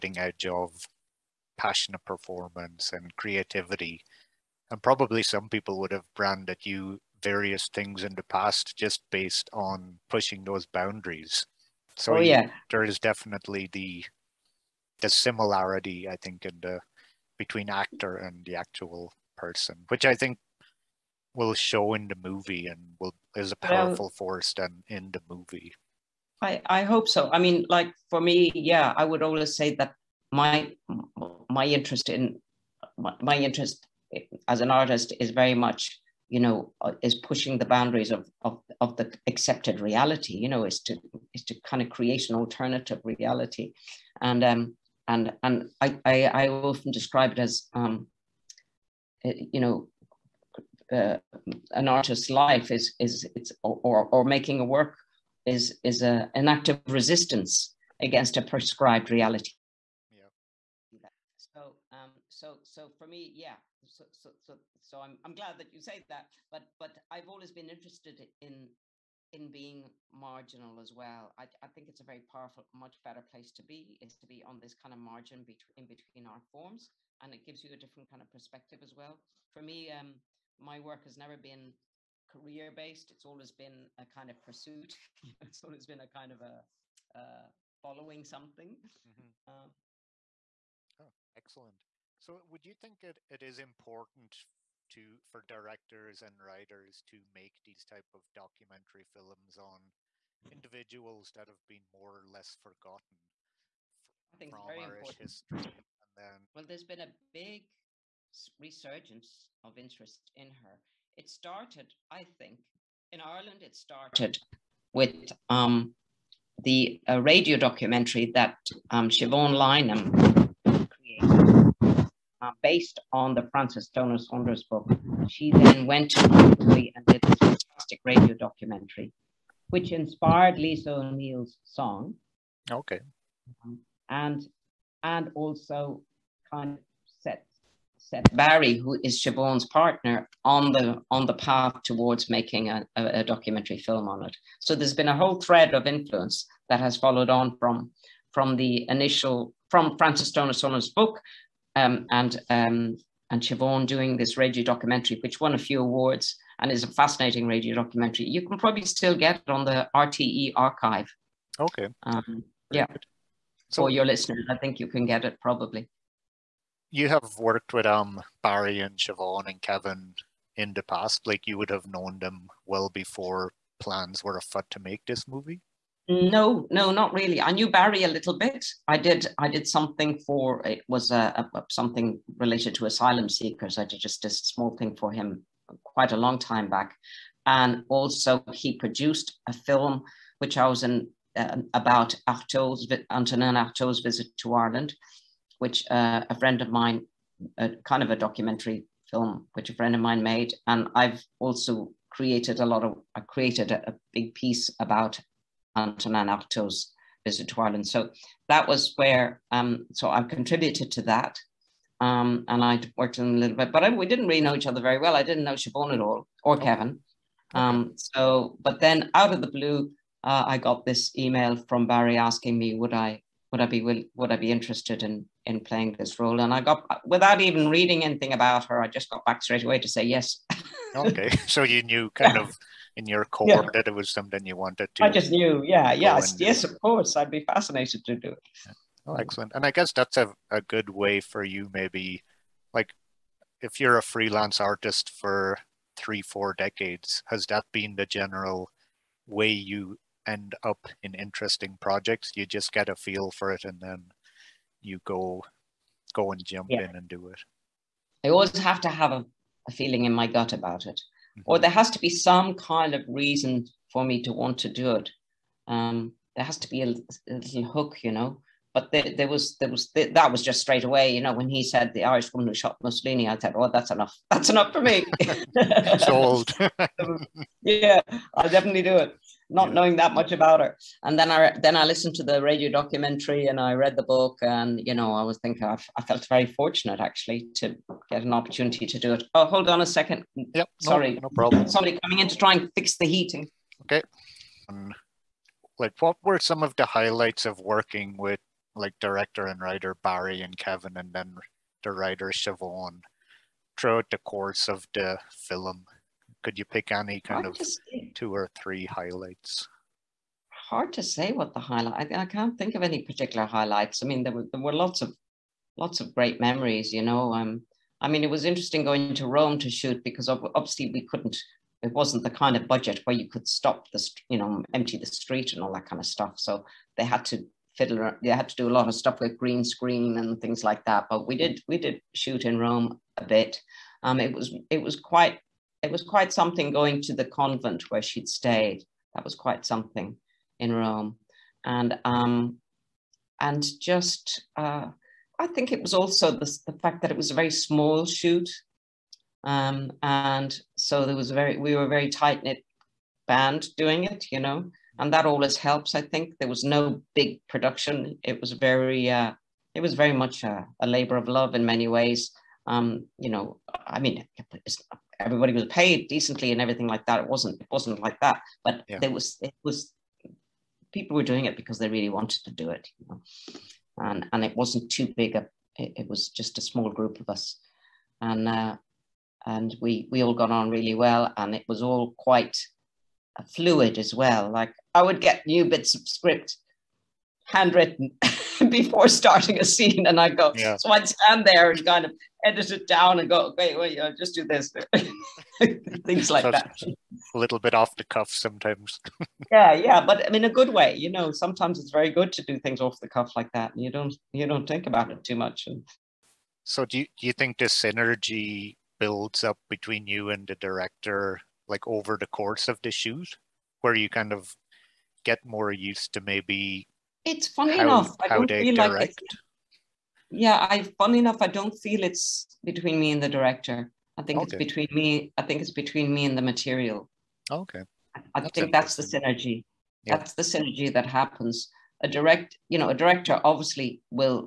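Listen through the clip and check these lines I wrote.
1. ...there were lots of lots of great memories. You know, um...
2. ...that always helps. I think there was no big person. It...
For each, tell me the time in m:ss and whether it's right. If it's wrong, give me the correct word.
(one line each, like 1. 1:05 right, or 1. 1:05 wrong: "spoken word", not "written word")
1. 5:14 right
2. 5:55 wrong: "production", not "person".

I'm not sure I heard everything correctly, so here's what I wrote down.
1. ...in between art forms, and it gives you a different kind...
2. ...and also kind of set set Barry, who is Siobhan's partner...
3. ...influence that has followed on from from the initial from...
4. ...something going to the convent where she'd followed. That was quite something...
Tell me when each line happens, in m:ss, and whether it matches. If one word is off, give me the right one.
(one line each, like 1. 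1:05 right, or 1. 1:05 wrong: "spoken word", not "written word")
1. 1:15 right
2. 2:15 right
3. 2:25 right
4. 5:36 wrong: "stayed", not "followed".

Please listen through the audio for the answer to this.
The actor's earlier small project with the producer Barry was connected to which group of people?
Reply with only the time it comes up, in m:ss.
3:02.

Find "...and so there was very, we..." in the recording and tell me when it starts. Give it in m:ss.
5:50.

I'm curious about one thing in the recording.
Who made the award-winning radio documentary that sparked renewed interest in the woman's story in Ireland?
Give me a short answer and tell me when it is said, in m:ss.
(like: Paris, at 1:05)
Siobhan Lynam, at 1:59.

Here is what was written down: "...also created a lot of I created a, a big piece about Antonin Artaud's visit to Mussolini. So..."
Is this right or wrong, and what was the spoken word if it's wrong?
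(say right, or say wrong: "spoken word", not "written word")
wrong: "Ireland", not "Mussolini".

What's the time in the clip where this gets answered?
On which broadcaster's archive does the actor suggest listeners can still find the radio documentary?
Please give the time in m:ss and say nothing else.
2:39.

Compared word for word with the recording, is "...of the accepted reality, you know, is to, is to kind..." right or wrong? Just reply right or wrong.
right.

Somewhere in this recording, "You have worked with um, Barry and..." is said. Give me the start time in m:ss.
2:46.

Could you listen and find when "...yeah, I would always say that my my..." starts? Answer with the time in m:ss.
0:28.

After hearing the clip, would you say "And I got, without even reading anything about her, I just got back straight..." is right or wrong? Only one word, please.
right.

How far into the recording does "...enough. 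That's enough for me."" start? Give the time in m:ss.
4:33.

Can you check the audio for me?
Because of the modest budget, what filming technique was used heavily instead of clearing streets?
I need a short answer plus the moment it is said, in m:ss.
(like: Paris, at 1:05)
green screen, at 5:29.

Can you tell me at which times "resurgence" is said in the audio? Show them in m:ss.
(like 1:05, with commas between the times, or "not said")
1:48.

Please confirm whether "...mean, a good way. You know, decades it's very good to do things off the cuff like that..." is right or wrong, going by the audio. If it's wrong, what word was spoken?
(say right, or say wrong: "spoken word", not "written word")
wrong: "sometimes", not "decades".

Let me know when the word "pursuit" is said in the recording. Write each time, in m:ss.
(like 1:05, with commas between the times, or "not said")
1:24.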